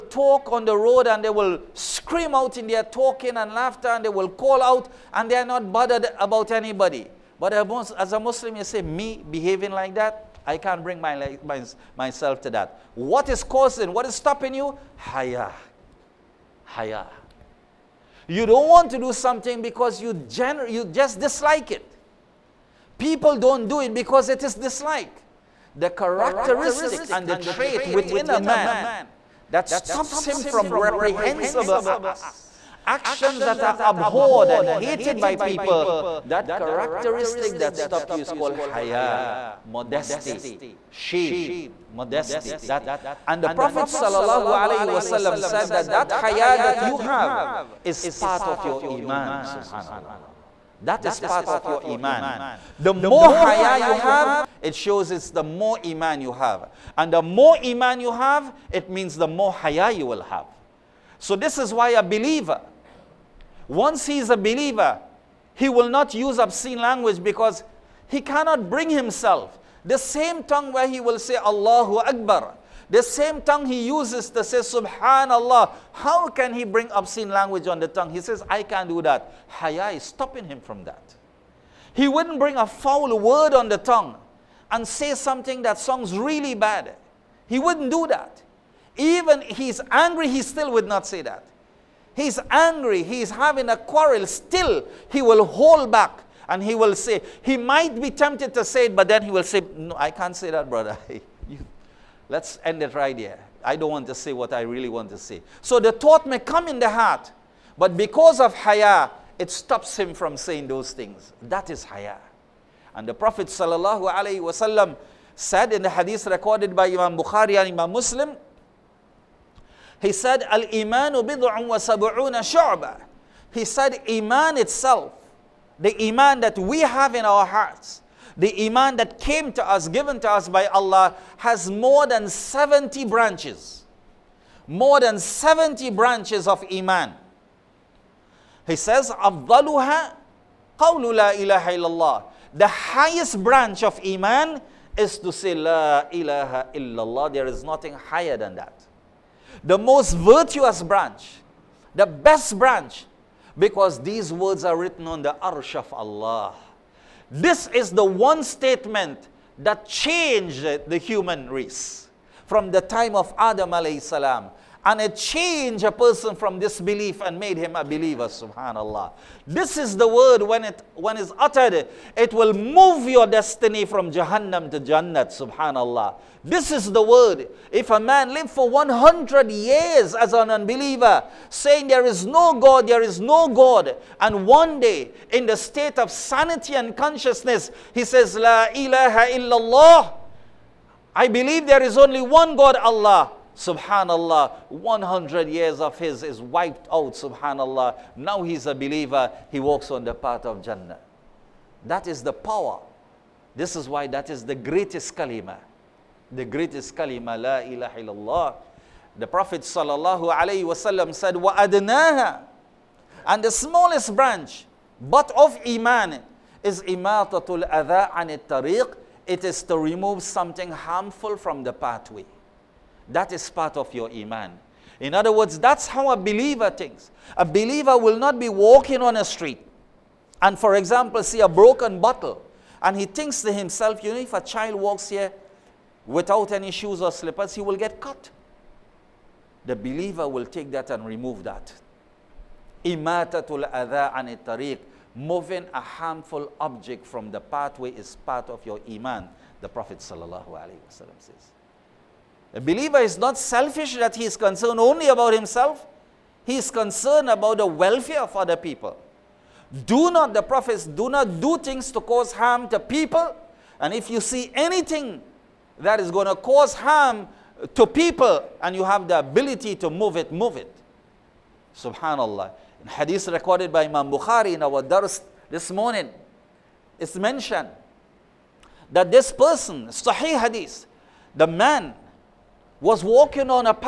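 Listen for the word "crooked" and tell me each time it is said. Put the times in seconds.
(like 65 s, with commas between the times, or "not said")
not said.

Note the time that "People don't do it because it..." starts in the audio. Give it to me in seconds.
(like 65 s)
22 s.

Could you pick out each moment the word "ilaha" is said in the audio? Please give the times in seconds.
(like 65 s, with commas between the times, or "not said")
141 s, 146 s, 188 s, 207 s.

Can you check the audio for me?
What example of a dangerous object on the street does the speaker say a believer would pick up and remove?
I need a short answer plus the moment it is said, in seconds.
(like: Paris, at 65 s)
A broken bottle, at 231 s.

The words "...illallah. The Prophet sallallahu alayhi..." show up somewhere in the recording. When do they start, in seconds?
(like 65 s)
207 s.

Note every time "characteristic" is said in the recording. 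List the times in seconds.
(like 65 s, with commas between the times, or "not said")
25 s, 36 s.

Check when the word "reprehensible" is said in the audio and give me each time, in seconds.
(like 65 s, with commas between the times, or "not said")
30 s.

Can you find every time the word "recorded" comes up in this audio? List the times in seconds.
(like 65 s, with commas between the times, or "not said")
116 s, 273 s.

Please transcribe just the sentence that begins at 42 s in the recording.
That, and the Prophet ﷺ said that that haya that you have is part of your iman, subhanallah.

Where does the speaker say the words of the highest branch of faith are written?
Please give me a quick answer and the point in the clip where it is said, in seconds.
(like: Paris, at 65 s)
On the arsh of Allah, at 155 s.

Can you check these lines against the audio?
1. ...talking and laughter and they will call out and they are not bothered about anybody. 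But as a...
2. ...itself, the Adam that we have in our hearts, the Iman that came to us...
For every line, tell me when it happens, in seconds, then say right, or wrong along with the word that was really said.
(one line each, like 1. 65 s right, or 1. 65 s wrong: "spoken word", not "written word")
1. 2 s right
2. 124 s wrong: "Iman", not "Adam".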